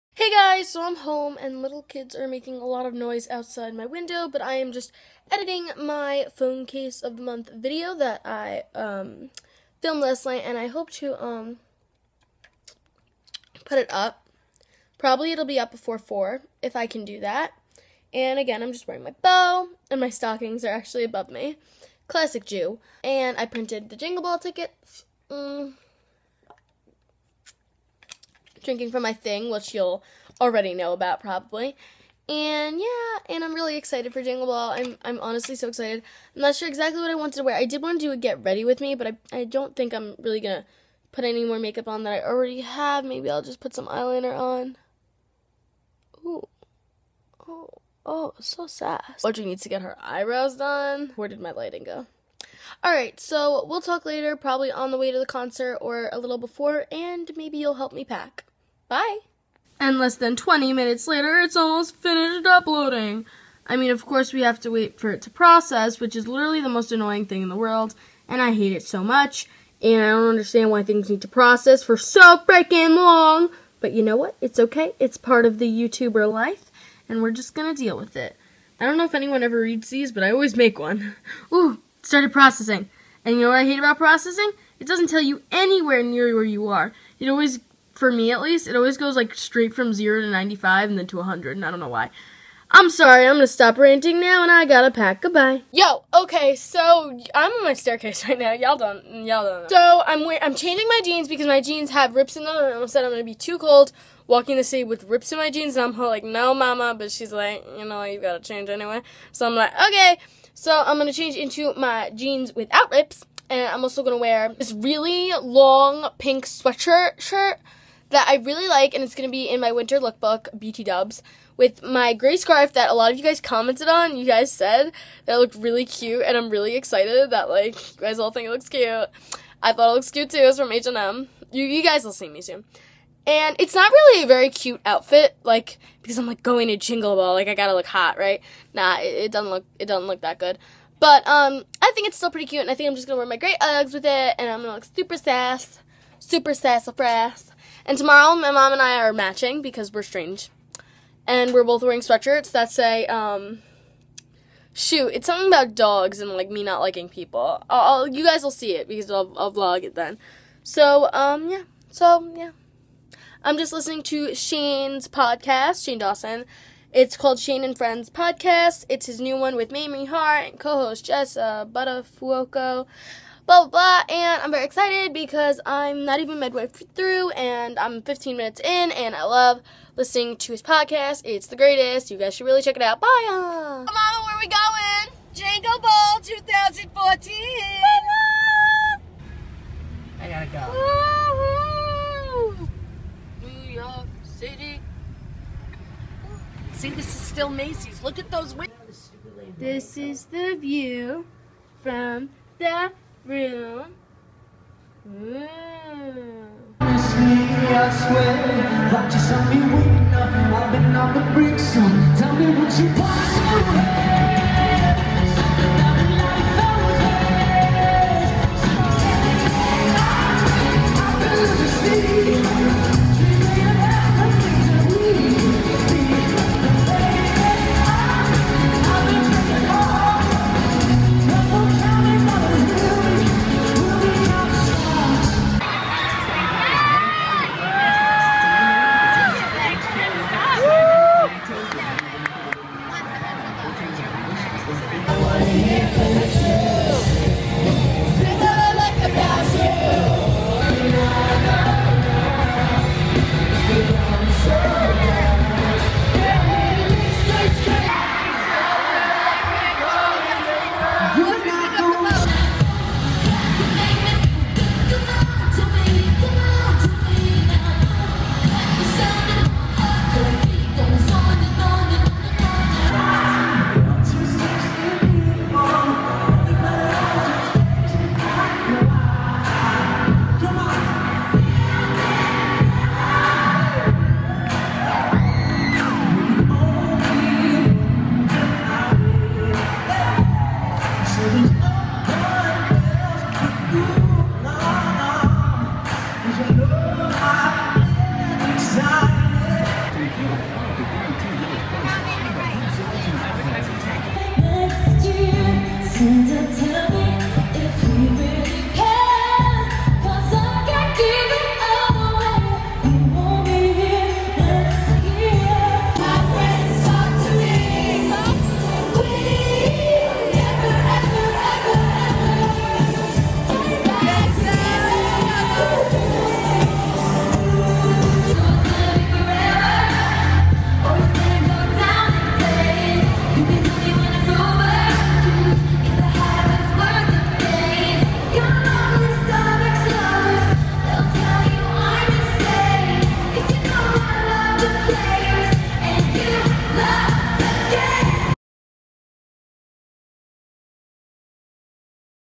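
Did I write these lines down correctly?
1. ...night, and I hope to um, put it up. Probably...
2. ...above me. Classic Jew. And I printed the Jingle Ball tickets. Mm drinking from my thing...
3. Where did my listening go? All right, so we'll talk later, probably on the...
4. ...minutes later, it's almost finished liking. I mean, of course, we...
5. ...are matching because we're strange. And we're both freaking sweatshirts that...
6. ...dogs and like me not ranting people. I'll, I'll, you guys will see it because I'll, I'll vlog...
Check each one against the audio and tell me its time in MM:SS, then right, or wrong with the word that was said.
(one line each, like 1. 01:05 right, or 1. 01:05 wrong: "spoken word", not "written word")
1. 00:10 right
2. 00:21 right
3. 00:51 wrong: "lighting", not "listening"
4. 01:00 wrong: "uploading", not "liking"
5. 02:28 wrong: "wearing", not "freaking"
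6. 02:35 wrong: "liking", not "ranting".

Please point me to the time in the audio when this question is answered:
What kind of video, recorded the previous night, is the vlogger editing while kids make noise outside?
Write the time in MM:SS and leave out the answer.
00:06.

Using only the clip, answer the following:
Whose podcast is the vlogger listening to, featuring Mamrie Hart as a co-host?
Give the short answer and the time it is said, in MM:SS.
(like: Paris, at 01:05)
Shane Dawson, at 02:45.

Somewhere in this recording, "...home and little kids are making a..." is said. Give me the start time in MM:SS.
00:00.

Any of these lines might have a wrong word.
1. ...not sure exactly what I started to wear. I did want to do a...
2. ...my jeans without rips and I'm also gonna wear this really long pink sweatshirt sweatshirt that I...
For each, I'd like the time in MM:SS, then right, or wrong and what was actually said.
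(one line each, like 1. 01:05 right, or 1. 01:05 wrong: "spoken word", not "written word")
1. 00:36 wrong: "wanted", not "started"
2. 01:51 wrong: "shirt", not "sweatshirt".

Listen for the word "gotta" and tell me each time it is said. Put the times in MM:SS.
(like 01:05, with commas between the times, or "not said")
01:34, 01:48, 02:17, 03:10.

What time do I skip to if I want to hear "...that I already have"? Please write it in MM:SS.
00:42.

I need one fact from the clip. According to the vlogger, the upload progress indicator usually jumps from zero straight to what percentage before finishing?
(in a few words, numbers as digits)
95.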